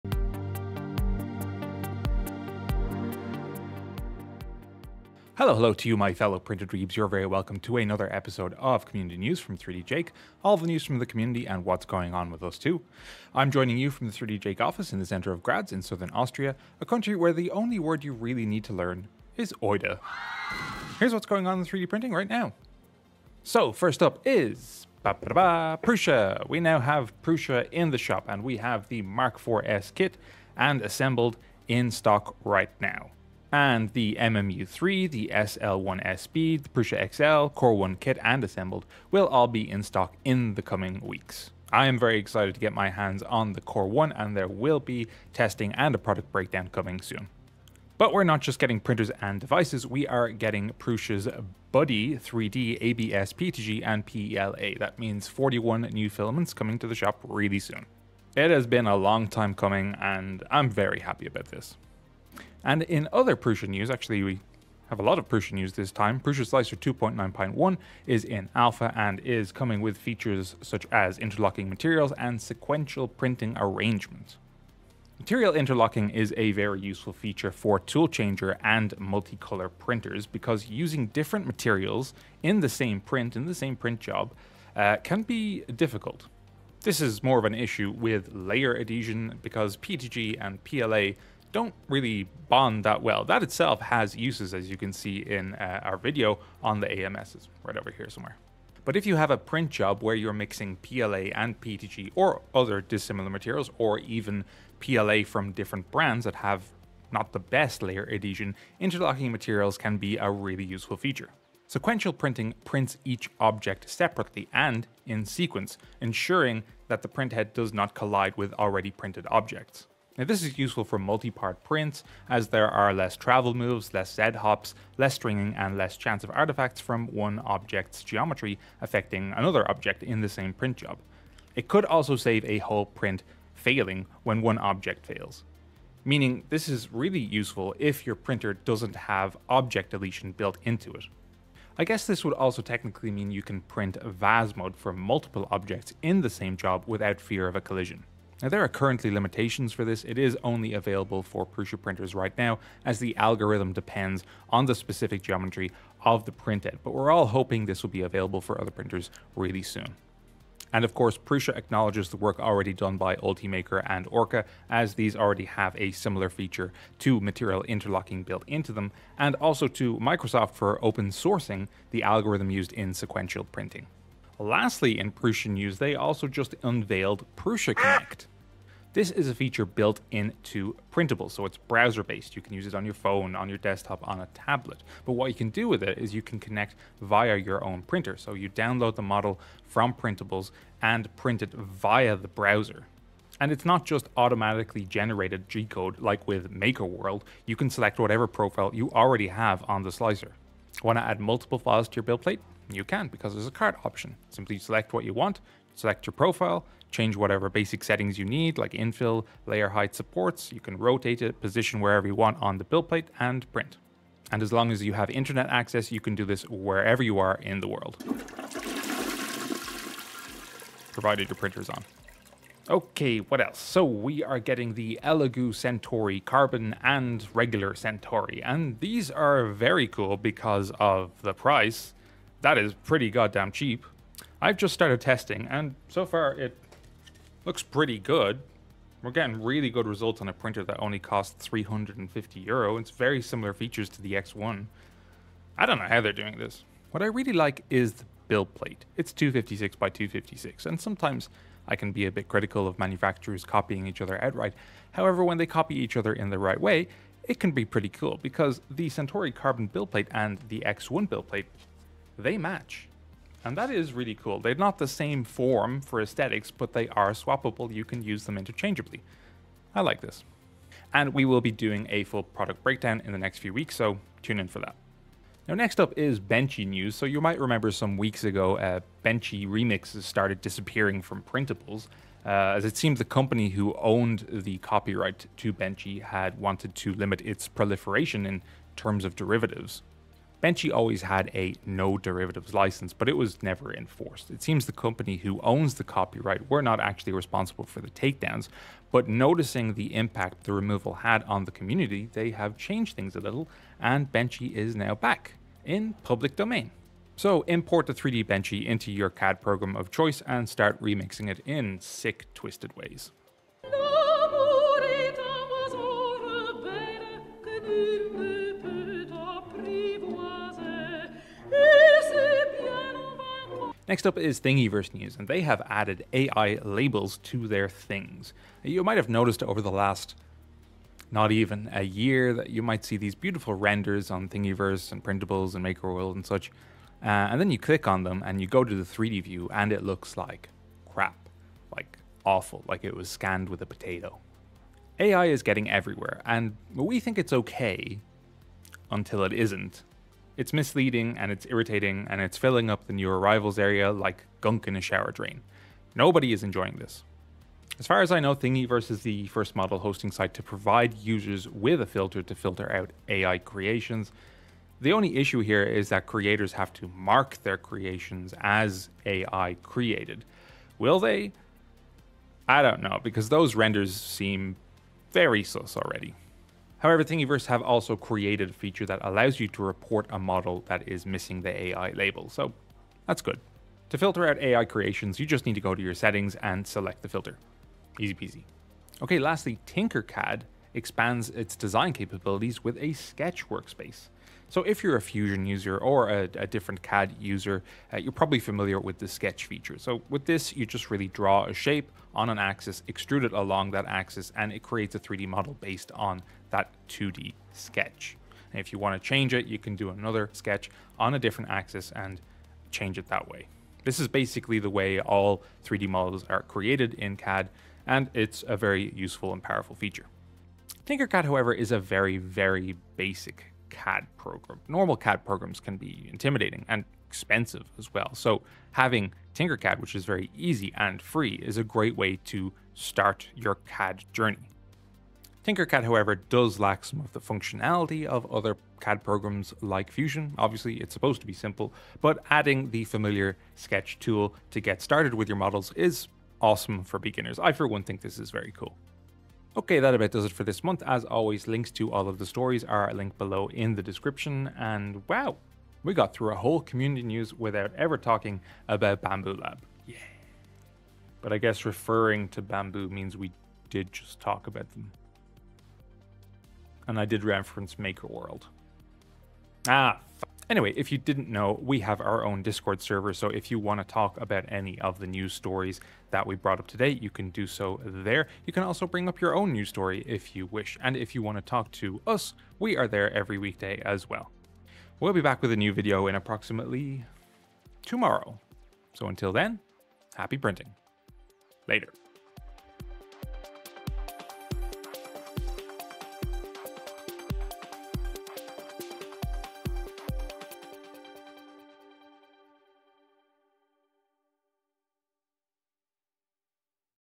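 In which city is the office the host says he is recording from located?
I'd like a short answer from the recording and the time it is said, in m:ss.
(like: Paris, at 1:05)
Graz, at 0:15.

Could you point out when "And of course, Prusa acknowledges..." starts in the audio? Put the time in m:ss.
2:40.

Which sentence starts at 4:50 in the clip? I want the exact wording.
Benchy always had a no derivatives license, but it was never enforced.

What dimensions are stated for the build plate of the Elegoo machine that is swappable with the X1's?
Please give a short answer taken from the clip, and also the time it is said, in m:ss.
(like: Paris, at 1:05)
256 by 256, at 4:09.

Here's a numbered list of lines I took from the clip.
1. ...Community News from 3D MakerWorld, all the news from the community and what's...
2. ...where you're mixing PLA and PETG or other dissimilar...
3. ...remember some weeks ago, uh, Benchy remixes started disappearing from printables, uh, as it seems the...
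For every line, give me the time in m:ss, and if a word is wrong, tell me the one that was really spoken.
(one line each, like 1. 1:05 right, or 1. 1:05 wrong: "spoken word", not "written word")
1. 0:08 wrong: "Jake", not "MakerWorld"
2. 1:40 right
3. 4:37 right.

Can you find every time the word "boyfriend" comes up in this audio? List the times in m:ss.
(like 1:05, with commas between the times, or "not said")
not said.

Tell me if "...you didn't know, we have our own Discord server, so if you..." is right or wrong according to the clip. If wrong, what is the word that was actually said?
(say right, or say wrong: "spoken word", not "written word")
right.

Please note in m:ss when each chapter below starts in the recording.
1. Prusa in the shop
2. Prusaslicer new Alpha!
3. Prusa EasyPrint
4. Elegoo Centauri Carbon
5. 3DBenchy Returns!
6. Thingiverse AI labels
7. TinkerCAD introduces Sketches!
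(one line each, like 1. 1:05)
1. 0:23
2. 1:05
3. 2:54
4. 3:43
5. 4:35
6. 5:24
7. 6:29.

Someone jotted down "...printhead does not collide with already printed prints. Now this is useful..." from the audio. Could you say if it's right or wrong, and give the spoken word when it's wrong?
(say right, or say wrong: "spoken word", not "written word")
wrong: "objects", not "prints".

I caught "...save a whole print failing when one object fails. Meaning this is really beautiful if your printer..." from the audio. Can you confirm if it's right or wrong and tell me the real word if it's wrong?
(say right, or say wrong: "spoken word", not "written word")
wrong: "useful", not "beautiful".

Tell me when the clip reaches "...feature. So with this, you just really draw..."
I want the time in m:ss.
6:39.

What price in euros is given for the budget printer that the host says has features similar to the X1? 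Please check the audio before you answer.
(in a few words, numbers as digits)
350 euro.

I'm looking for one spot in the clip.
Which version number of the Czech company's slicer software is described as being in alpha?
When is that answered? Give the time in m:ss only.
1:06.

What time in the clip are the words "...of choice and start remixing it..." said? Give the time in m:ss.
5:09.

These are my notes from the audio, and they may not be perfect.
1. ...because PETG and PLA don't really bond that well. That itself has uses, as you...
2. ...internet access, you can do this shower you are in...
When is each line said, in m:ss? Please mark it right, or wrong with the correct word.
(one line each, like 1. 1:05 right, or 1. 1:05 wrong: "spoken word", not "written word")
1. 1:29 right
2. 3:35 wrong: "wherever", not "shower".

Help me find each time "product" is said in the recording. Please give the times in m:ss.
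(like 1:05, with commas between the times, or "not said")
0:45, 4:32.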